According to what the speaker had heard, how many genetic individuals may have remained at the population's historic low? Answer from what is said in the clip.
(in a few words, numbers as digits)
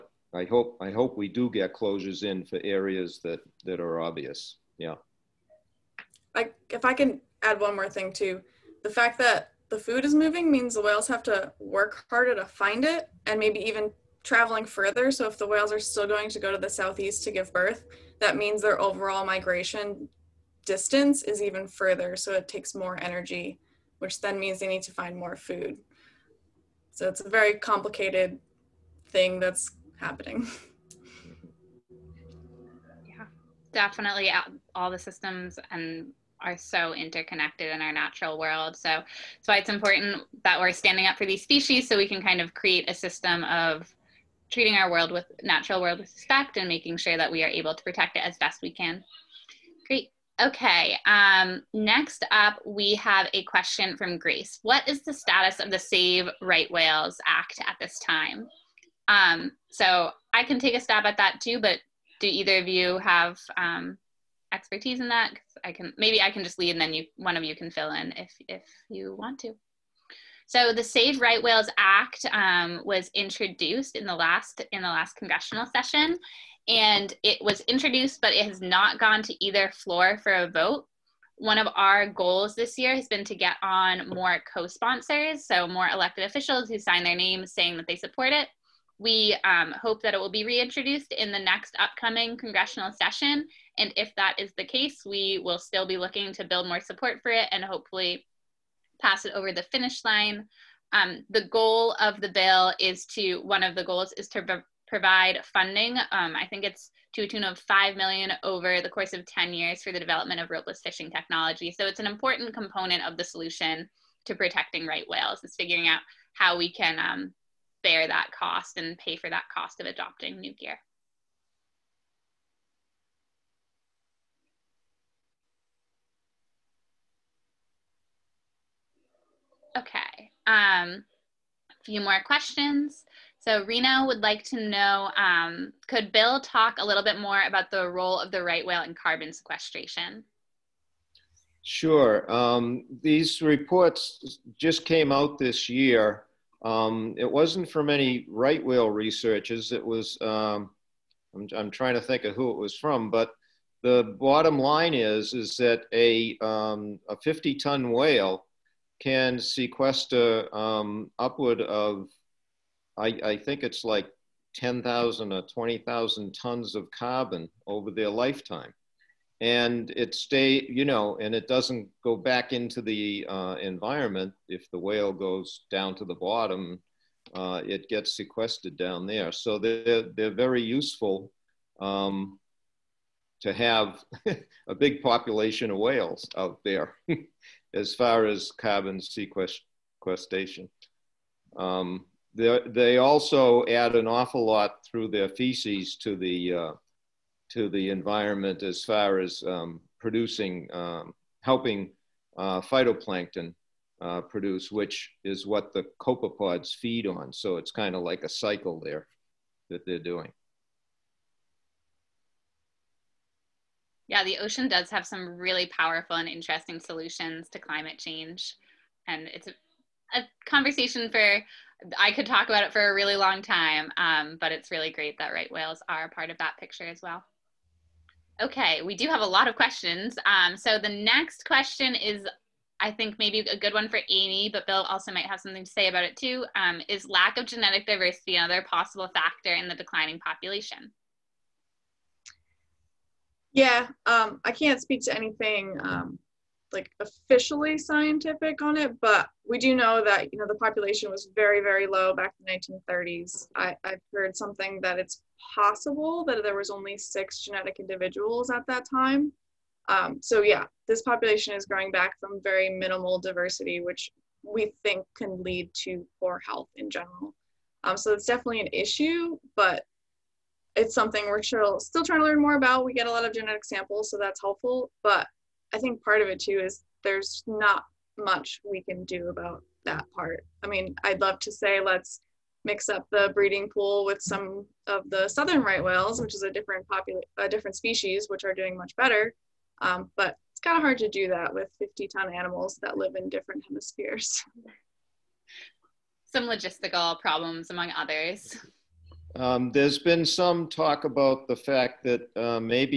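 6.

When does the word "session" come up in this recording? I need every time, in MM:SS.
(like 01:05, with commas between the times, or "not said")
01:15, 01:32.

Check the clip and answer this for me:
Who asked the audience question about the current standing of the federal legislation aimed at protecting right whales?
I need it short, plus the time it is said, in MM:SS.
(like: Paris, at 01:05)
Grace, at 00:54.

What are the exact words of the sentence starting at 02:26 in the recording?
Um, it wasn't from any right whale researchers.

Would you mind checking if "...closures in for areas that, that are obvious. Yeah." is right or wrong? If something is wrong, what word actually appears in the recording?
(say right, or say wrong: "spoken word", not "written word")
right.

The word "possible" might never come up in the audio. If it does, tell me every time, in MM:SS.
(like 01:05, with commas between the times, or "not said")
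03:58, 04:15.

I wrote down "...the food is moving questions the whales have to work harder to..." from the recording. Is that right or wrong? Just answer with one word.
wrong.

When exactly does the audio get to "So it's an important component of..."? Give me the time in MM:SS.
01:51.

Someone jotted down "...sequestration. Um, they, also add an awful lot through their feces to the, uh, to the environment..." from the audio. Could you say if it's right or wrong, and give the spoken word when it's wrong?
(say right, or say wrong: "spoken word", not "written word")
right.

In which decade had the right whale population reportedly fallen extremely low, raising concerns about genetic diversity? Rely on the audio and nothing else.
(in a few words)
1930s.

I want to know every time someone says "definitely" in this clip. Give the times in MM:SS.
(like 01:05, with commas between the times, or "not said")
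00:33, 04:28.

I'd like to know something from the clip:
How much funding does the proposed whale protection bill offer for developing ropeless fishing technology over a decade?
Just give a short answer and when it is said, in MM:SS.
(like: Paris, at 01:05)
5 million, at 01:47.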